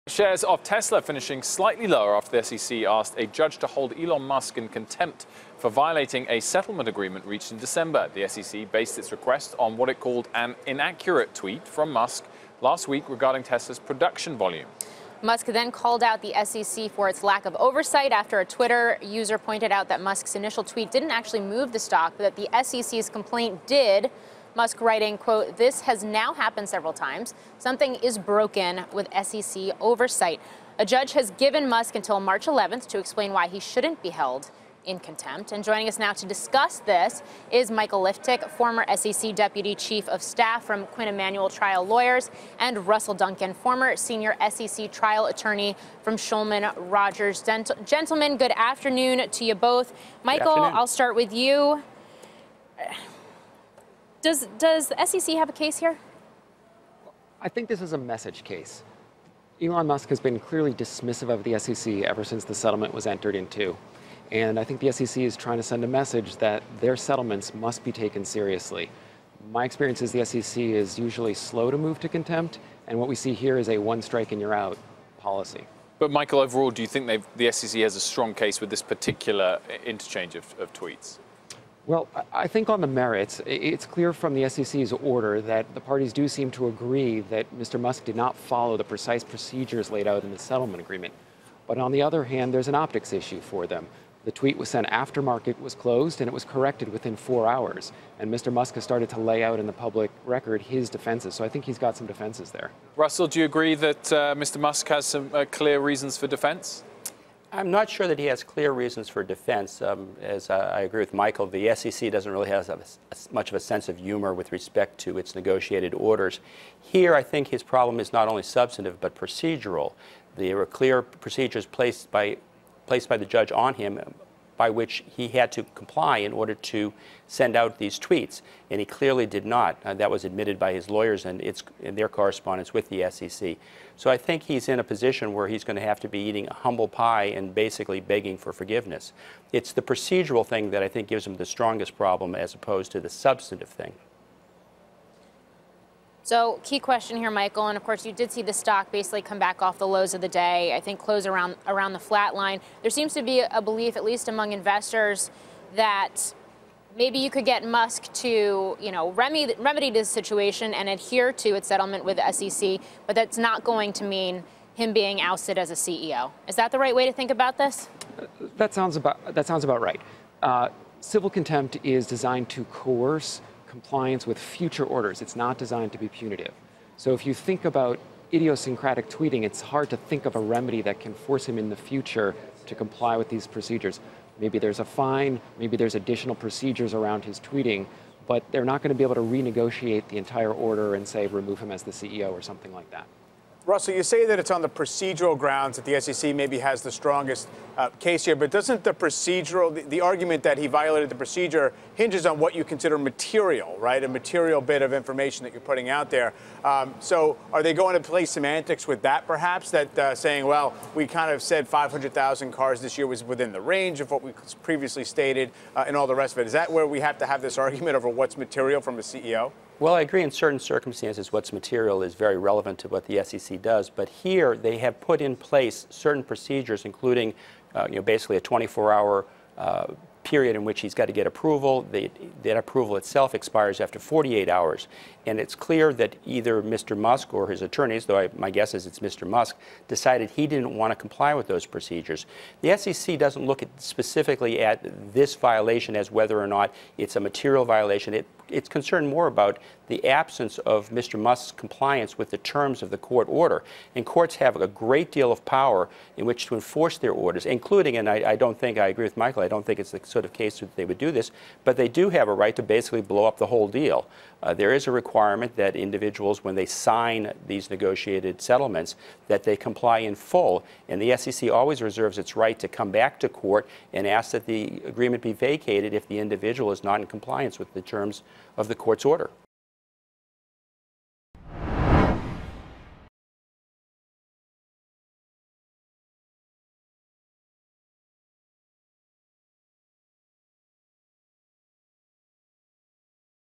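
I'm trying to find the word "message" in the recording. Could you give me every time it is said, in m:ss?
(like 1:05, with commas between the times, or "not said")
0:57, 1:05.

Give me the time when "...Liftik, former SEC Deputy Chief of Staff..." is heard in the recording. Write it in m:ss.
0:38.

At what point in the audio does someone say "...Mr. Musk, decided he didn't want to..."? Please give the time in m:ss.
3:58.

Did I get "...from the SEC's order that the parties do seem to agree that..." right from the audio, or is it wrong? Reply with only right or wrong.
right.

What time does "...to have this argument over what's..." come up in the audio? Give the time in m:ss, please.
3:37.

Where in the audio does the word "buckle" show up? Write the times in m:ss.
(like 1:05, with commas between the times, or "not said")
not said.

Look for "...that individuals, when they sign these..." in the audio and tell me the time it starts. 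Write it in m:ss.
4:25.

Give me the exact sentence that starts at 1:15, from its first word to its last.
But Michael, overall, do you think the SEC has a strong case with this particular interchange of, of tweets?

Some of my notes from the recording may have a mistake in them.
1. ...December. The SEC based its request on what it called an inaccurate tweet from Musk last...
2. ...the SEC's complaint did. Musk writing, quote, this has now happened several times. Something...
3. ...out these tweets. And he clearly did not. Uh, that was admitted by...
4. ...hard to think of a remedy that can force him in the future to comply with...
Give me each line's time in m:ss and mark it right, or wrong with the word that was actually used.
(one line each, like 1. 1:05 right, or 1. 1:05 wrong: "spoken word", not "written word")
1. 0:07 right
2. 0:22 right
3. 2:07 right
4. 2:59 right.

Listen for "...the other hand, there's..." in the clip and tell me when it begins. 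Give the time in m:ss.
1:31.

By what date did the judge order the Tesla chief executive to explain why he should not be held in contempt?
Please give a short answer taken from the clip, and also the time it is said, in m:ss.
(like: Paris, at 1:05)
March 11th, at 0:32.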